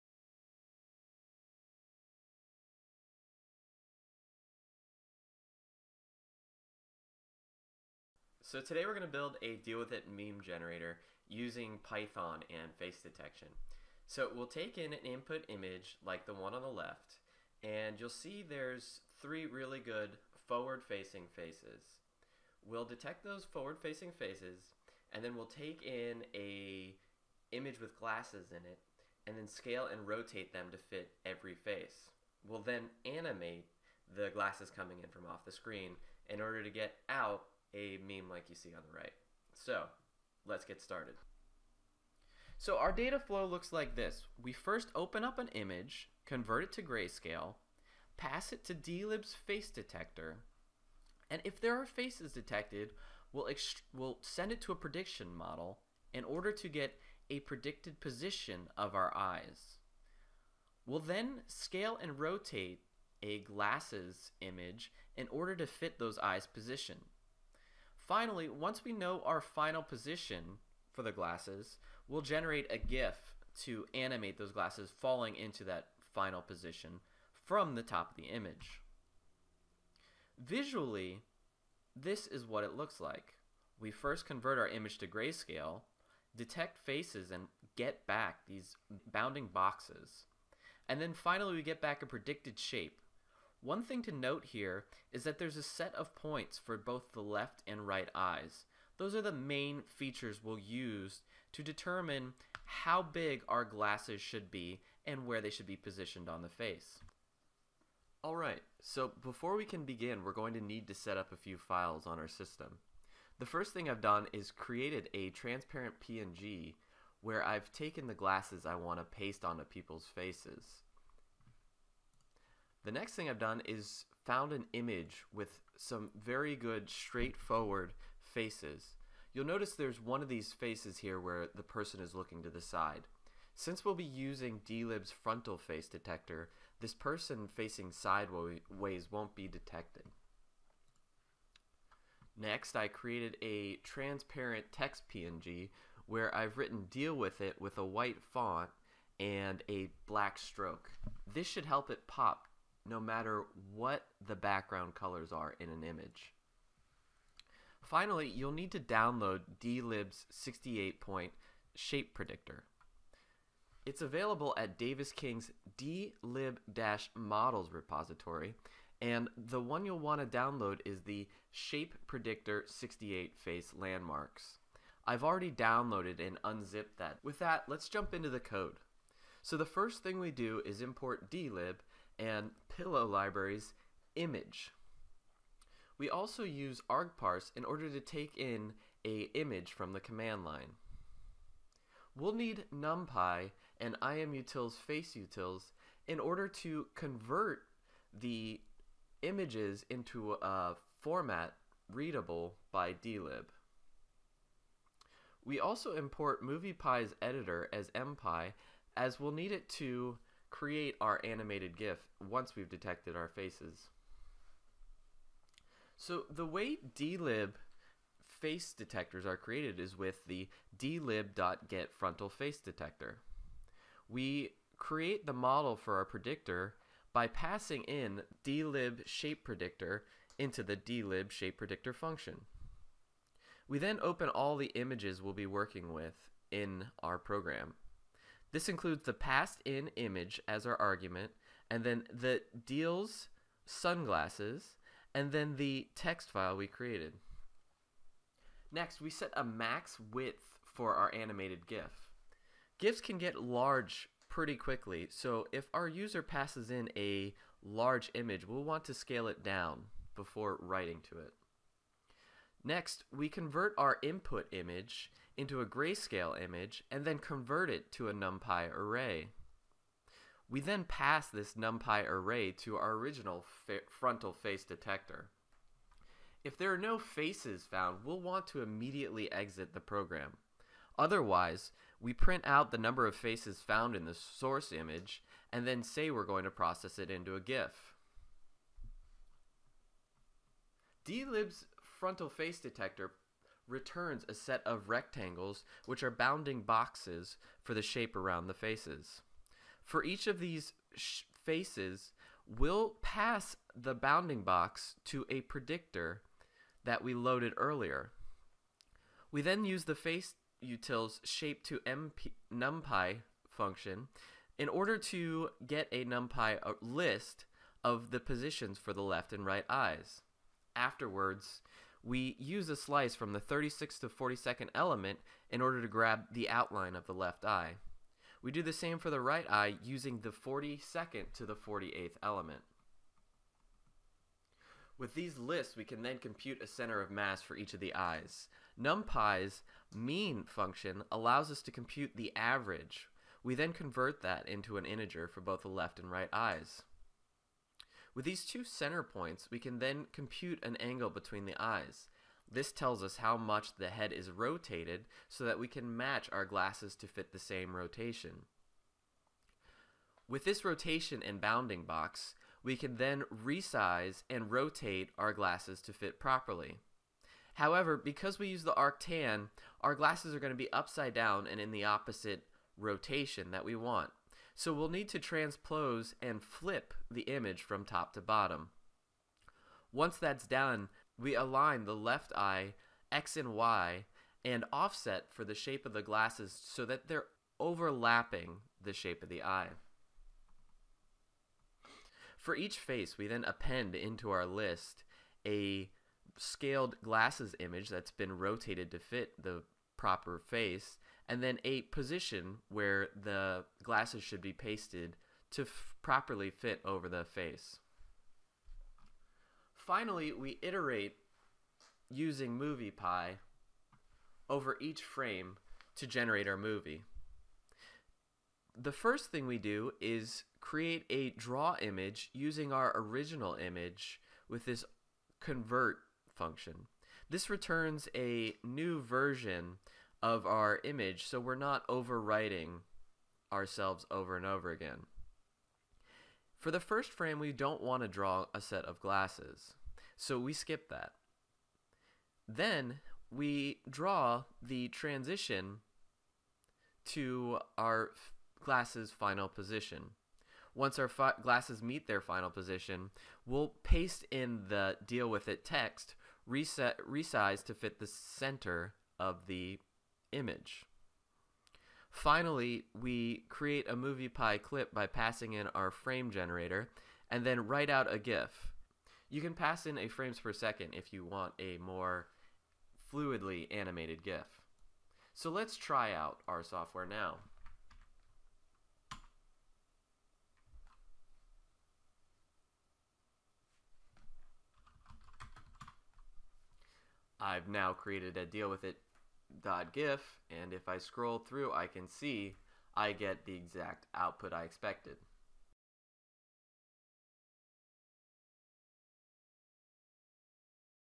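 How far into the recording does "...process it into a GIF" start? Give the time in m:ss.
4:46.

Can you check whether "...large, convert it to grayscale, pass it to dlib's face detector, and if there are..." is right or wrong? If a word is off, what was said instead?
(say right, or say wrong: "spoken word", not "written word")
wrong: "image", not "large".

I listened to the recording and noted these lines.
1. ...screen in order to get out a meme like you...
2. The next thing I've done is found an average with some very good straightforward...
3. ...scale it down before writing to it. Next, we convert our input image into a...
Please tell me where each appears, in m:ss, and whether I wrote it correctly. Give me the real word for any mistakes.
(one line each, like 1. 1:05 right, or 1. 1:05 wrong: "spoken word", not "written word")
1. 0:35 right
2. 2:02 wrong: "image", not "average"
3. 4:18 right.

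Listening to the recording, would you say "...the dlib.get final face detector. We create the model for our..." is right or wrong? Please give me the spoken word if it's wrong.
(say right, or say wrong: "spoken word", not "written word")
wrong: "frontal", not "final".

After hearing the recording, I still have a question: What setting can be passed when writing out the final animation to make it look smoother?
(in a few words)
Frames per second.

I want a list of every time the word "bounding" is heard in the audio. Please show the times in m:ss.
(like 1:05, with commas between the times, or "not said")
1:29, 4:56, 5:03, 6:01.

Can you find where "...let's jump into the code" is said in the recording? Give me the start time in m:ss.
2:57.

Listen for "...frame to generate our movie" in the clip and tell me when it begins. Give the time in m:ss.
6:55.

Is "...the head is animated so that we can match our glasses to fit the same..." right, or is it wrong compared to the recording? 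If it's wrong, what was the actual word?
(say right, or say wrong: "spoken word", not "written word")
wrong: "rotated", not "animated".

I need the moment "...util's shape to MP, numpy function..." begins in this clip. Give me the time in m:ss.
5:10.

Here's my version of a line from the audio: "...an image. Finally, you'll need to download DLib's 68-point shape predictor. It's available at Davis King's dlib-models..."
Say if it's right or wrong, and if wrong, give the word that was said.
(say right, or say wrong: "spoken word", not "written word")
right.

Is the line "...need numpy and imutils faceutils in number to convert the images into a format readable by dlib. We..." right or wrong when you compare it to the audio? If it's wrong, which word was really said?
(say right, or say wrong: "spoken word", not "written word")
wrong: "order", not "number".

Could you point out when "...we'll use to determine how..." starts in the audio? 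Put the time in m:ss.
1:40.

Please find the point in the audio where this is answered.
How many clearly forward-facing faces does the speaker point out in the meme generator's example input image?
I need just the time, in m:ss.
0:19.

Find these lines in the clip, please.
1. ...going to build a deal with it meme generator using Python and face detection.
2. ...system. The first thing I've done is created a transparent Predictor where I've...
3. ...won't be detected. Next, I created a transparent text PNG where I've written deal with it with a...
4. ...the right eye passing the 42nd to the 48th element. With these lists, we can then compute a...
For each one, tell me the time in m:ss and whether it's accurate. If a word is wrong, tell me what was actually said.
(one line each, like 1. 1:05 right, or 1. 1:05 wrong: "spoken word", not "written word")
1. 0:08 right
2. 1:52 wrong: "PNG", not "Predictor"
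3. 2:19 right
4. 5:29 wrong: "using", not "passing".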